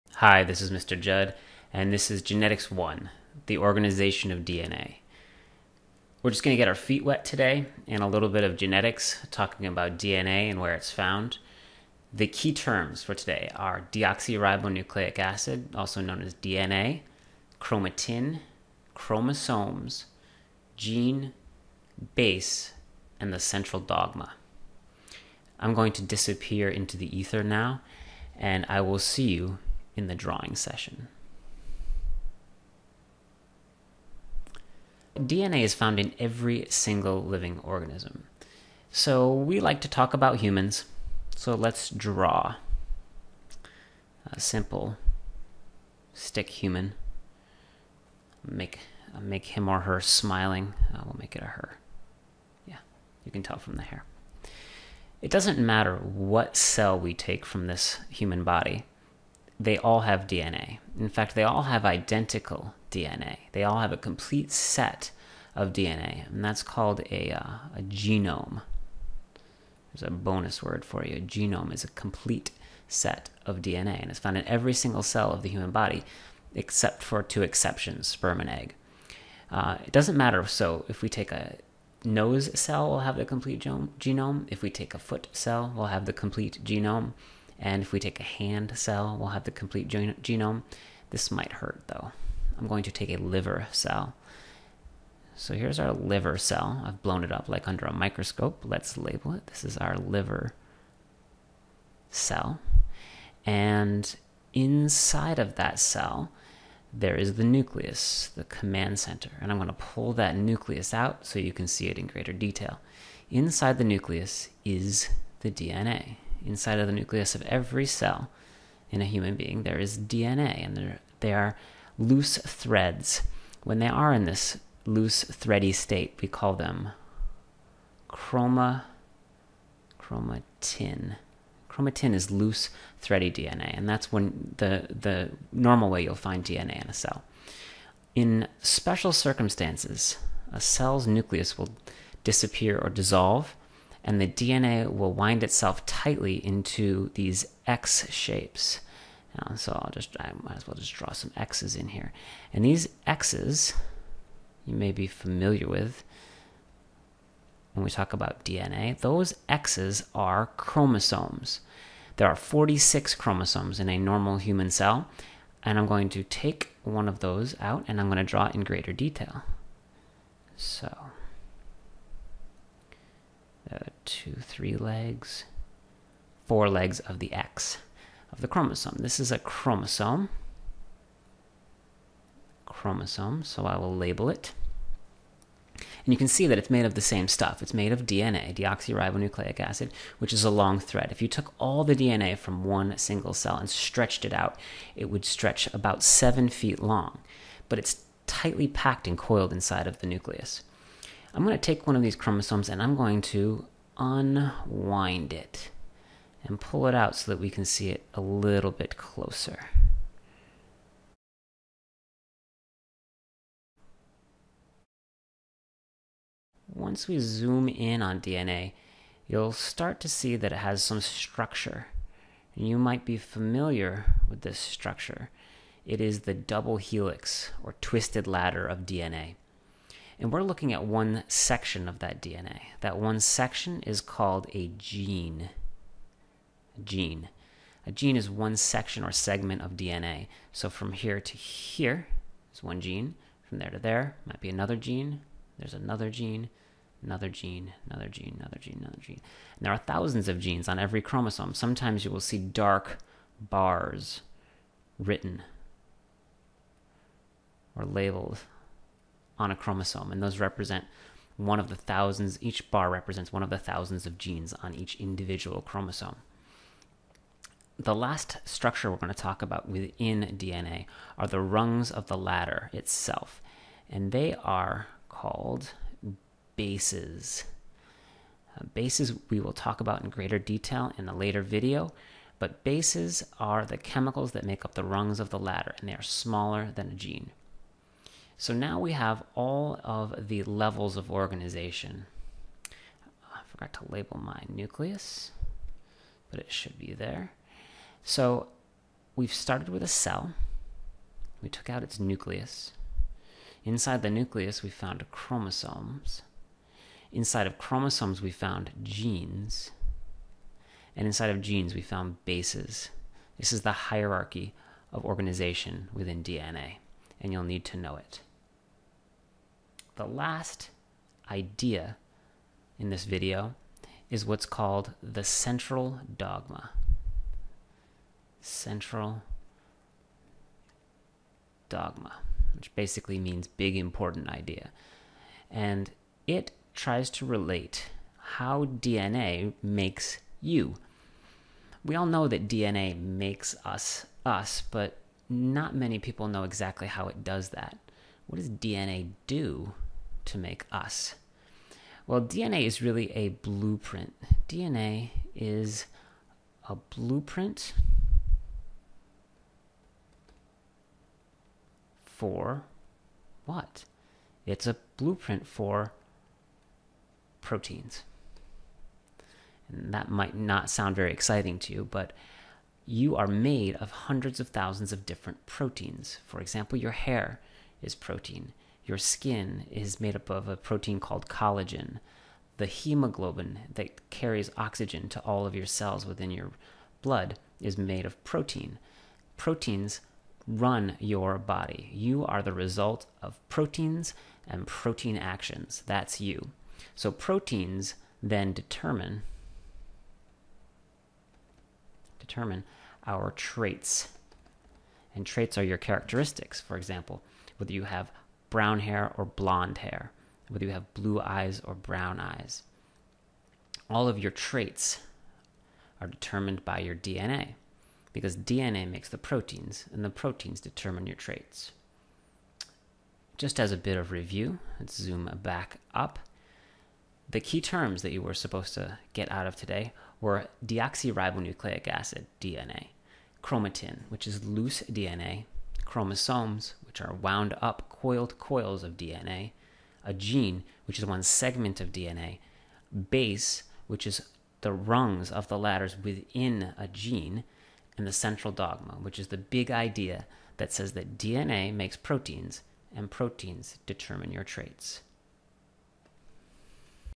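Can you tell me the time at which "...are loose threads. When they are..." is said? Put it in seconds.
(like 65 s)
121 s.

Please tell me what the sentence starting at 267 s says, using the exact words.
The last structure we're going to talk about within DNA are the rungs of the ladder itself, and they are called bases.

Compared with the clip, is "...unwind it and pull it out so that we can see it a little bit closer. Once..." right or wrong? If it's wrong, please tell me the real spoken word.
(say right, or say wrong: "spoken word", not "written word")
right.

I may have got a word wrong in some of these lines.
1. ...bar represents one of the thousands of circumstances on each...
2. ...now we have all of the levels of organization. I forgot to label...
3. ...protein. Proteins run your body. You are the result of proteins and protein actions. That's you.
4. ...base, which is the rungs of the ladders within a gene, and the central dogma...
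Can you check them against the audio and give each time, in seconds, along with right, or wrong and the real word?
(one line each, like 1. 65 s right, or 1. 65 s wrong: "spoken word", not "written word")
1. 262 s wrong: "genes", not "circumstances"
2. 288 s right
3. 388 s right
4. 443 s right.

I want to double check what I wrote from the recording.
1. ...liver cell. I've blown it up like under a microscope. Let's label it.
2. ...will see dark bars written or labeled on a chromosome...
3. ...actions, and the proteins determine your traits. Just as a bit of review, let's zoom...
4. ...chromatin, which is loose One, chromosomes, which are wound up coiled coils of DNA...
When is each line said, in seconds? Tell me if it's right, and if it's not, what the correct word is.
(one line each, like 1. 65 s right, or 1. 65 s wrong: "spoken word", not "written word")
1. 95 s right
2. 252 s right
3. 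419 s wrong: "proteins", not "actions"
4. 433 s wrong: "DNA", not "One".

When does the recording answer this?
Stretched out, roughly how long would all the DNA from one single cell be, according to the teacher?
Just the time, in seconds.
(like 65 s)
196 s.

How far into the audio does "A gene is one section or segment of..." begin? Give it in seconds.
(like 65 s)
237 s.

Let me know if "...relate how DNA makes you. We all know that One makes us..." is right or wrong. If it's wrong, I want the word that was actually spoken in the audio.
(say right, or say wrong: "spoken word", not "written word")
wrong: "DNA", not "One".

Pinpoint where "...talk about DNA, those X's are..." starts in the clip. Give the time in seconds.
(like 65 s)
157 s.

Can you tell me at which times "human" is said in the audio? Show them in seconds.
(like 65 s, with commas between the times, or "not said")
40 s, 46 s, 58 s, 75 s, 119 s, 164 s.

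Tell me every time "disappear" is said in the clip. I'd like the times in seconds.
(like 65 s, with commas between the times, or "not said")
26 s, 142 s.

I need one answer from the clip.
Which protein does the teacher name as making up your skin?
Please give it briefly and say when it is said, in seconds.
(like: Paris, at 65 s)
Collagen, at 381 s.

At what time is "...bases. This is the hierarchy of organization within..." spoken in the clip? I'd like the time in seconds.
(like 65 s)
312 s.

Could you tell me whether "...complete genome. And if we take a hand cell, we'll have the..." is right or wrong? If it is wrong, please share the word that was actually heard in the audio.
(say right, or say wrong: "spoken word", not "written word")
right.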